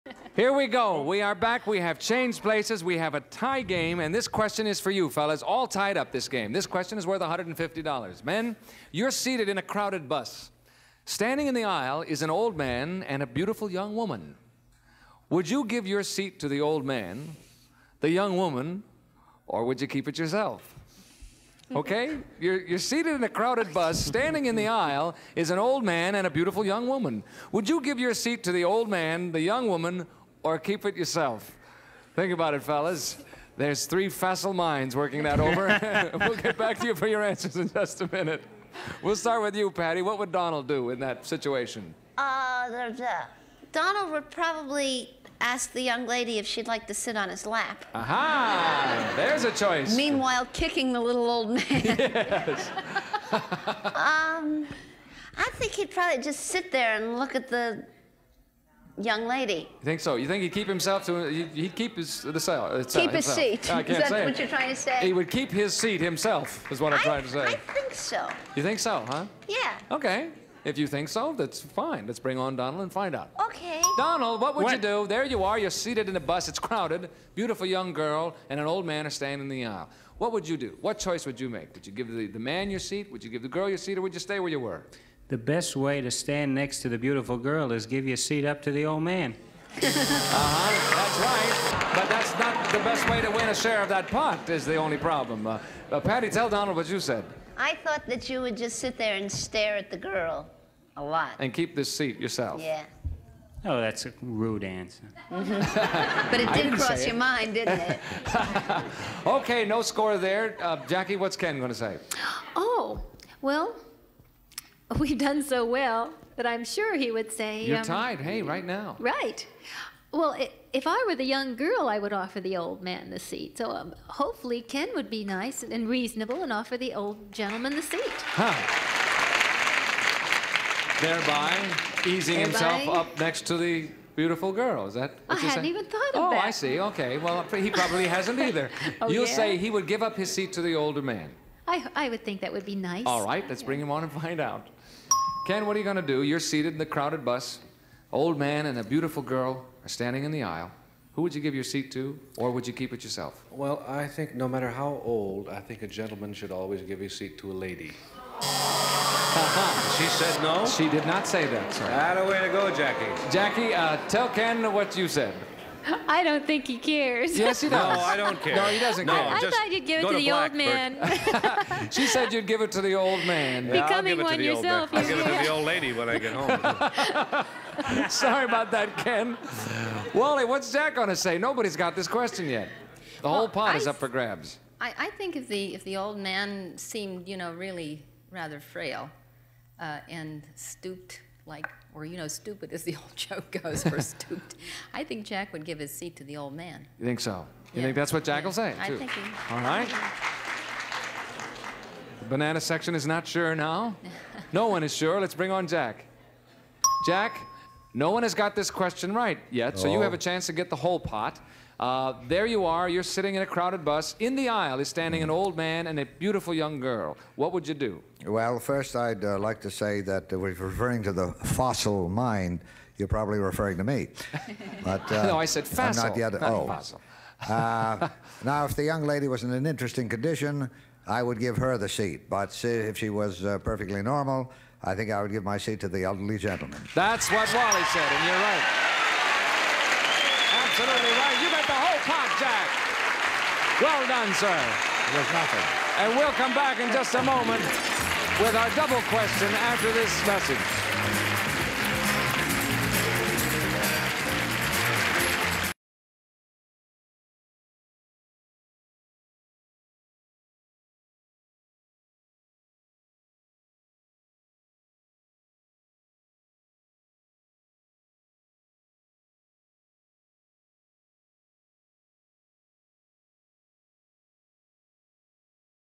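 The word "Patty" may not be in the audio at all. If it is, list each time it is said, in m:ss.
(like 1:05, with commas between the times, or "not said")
0:39, 1:36.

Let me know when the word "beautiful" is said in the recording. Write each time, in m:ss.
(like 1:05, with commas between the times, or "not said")
0:13, 0:26, 1:17, 1:26, 2:14, 2:28, 3:36.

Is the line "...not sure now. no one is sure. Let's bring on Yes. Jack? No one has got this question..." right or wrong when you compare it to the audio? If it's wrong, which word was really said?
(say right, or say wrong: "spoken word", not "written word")
wrong: "Jack", not "Yes".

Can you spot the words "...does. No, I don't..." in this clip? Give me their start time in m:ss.
2:47.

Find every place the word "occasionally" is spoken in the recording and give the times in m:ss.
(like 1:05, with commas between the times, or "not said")
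not said.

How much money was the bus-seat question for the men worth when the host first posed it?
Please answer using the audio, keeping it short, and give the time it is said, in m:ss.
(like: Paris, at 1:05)
$150, at 0:07.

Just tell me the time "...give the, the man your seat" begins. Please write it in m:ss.
1:21.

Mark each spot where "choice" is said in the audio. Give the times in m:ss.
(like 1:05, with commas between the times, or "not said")
0:49, 1:20.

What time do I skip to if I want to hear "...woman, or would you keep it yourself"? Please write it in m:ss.
0:18.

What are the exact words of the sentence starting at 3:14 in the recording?
I think Jack would give his seat to the old man.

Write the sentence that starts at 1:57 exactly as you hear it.
You're um, tied, hey, right now.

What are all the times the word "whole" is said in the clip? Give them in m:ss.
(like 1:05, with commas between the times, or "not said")
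3:03, 3:30, 4:01.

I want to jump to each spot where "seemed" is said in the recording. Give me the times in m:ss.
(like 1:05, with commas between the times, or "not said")
3:06.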